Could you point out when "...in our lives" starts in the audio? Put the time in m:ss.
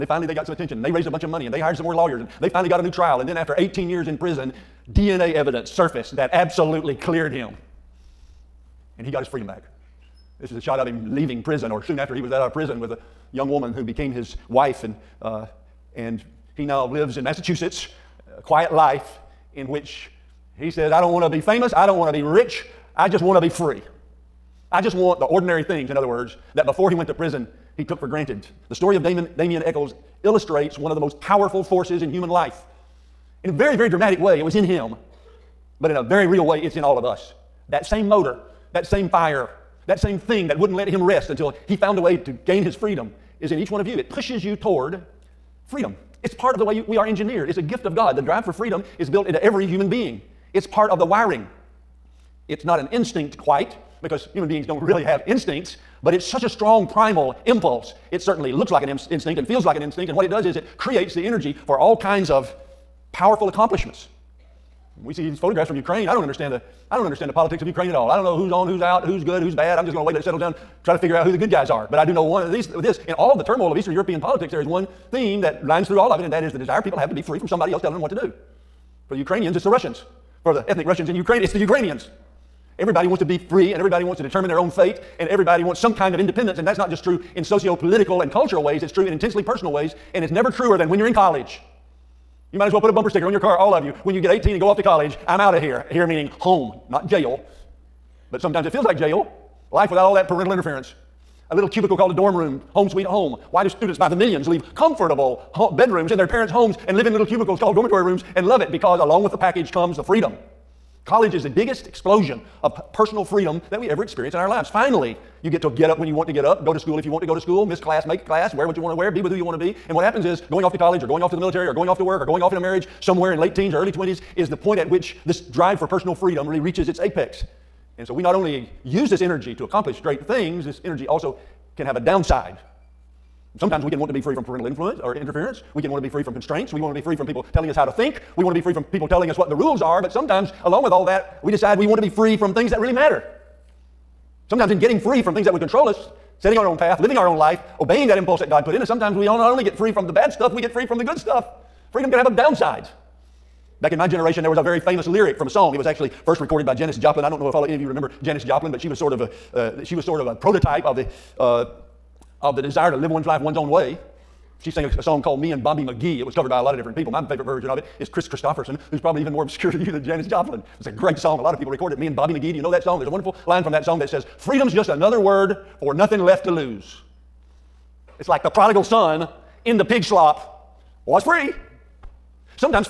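1:54.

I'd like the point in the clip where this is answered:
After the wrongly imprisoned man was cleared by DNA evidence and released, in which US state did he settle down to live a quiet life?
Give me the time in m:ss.
0:17.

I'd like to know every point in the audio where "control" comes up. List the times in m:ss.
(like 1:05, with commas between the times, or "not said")
2:25.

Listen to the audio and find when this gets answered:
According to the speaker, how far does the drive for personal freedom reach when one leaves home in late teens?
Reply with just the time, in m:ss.
2:06.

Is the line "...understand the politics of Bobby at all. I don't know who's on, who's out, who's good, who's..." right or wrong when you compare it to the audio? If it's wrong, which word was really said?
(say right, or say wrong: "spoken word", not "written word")
wrong: "Ukraine", not "Bobby".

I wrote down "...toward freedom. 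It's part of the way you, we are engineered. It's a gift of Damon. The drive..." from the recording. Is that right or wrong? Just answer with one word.
wrong.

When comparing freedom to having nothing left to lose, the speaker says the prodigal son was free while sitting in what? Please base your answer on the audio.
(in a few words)
the pig slop.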